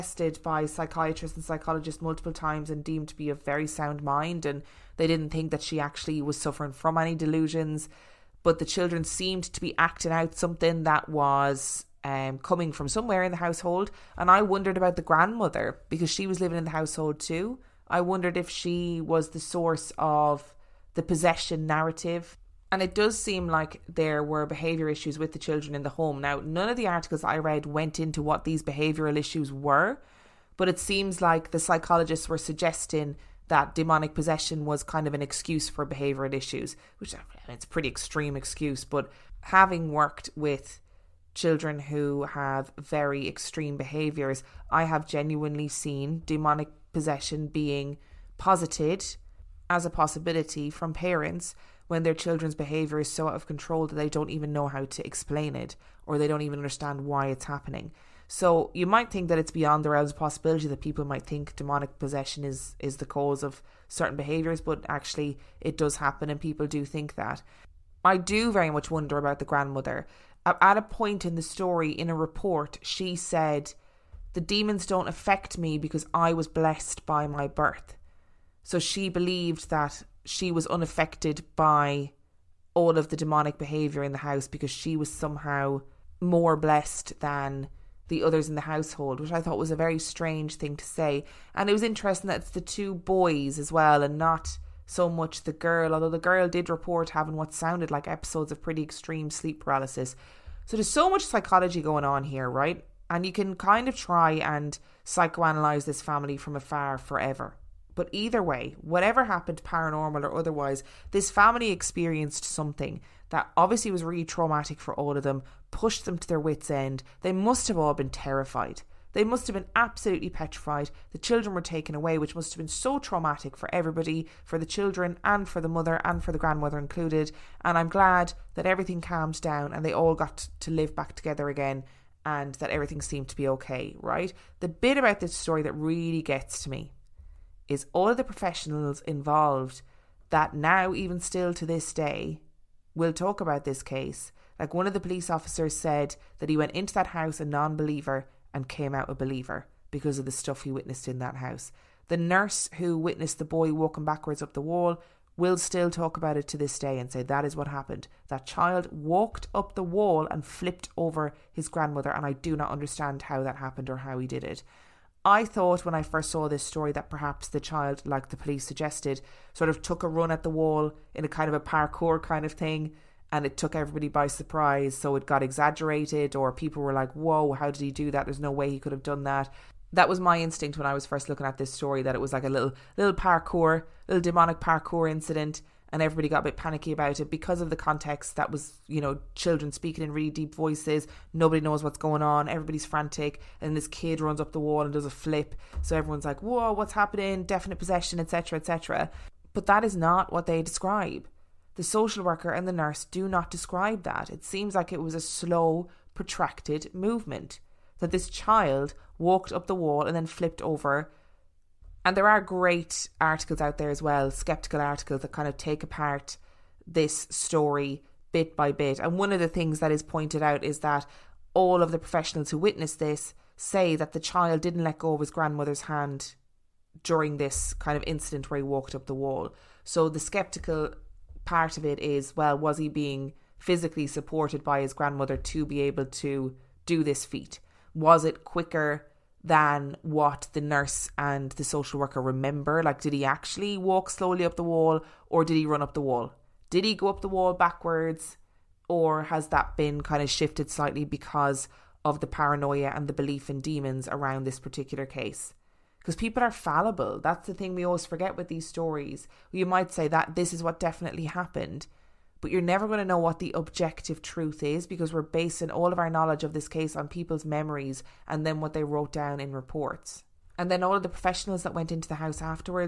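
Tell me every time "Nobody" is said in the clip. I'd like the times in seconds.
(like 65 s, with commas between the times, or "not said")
191 s.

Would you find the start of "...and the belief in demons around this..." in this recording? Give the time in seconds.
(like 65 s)
252 s.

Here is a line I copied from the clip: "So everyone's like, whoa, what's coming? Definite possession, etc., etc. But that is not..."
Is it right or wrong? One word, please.
wrong.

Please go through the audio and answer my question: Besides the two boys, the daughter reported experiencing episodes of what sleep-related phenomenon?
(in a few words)
Sleep paralysis.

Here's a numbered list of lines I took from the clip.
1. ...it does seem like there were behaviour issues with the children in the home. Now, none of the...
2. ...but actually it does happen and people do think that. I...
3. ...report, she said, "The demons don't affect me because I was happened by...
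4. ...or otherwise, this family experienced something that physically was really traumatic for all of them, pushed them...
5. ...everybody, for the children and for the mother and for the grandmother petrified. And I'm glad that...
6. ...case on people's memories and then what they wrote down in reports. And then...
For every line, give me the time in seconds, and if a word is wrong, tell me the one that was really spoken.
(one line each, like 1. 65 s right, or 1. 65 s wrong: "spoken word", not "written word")
1. 22 s right
2. 64 s right
3. 72 s wrong: "blessed", not "happened"
4. 110 s wrong: "obviously", not "physically"
5. 123 s wrong: "included", not "petrified"
6. 266 s right.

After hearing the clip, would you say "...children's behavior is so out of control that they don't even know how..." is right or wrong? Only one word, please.
right.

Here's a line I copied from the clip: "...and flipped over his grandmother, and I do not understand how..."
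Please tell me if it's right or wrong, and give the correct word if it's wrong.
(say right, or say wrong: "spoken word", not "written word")
right.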